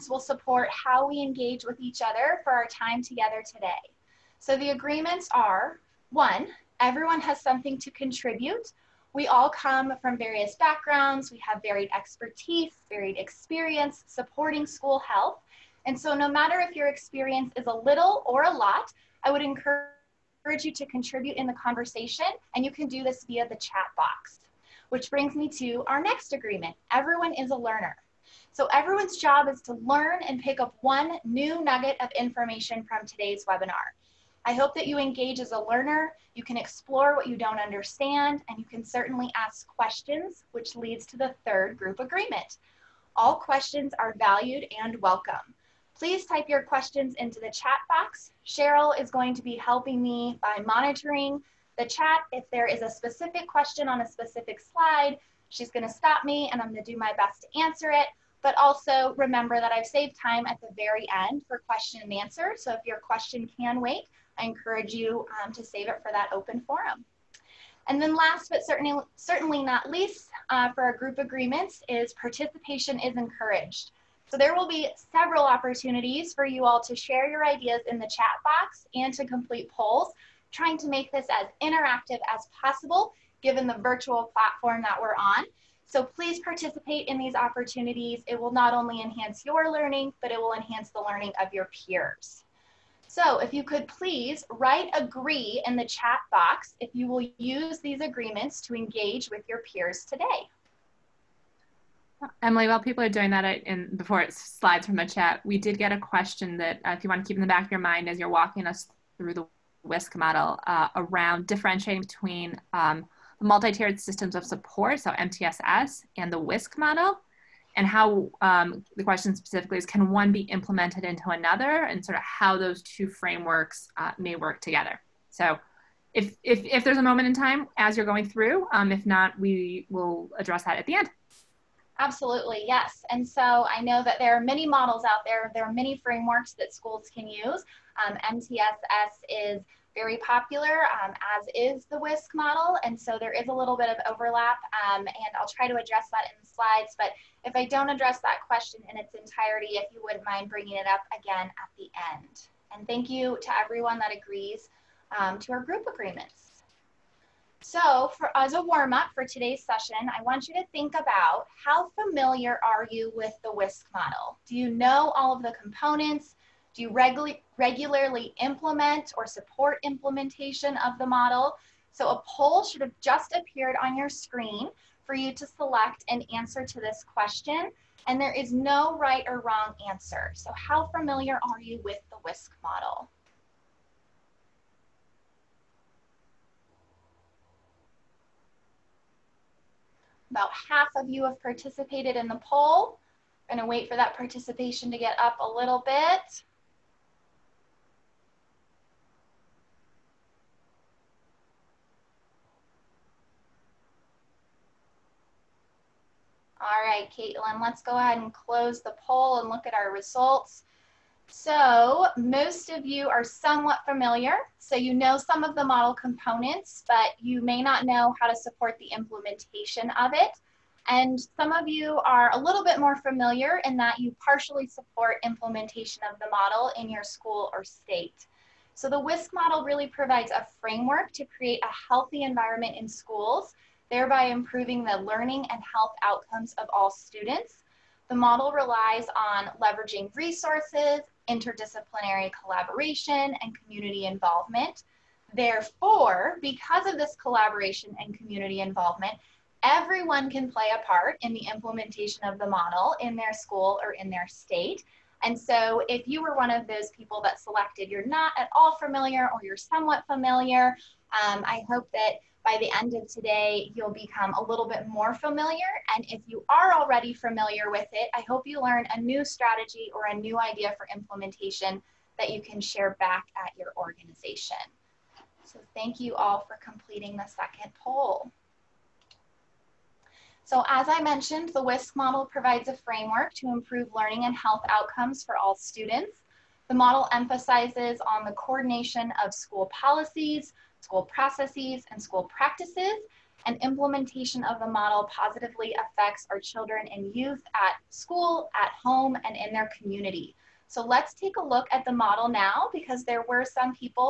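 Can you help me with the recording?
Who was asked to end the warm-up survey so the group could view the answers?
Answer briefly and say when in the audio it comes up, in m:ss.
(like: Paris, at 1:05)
Caitlin, at 3:27.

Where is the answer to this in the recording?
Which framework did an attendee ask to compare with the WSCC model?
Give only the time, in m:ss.
1:53.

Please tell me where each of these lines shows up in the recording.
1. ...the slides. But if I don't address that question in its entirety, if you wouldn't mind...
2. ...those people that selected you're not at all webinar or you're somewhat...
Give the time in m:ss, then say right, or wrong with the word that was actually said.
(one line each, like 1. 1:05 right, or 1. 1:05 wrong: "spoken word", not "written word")
1. 2:26 right
2. 4:16 wrong: "familiar", not "webinar".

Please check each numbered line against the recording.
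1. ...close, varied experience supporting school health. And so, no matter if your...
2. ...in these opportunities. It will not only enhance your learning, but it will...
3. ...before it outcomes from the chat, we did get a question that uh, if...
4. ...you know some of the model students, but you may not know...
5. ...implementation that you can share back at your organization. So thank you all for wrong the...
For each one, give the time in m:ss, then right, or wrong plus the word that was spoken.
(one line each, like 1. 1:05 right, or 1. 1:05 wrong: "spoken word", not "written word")
1. 0:11 wrong: "expertise", not "close"
2. 1:27 right
3. 1:43 wrong: "slides", not "outcomes"
4. 3:34 wrong: "components", not "students"
5. 4:30 wrong: "completing", not "wrong".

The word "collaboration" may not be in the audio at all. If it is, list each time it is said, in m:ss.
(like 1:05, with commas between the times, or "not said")
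4:02, 4:07.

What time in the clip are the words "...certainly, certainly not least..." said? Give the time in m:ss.
1:08.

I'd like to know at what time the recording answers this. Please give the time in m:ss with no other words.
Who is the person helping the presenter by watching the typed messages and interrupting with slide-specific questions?
0:48.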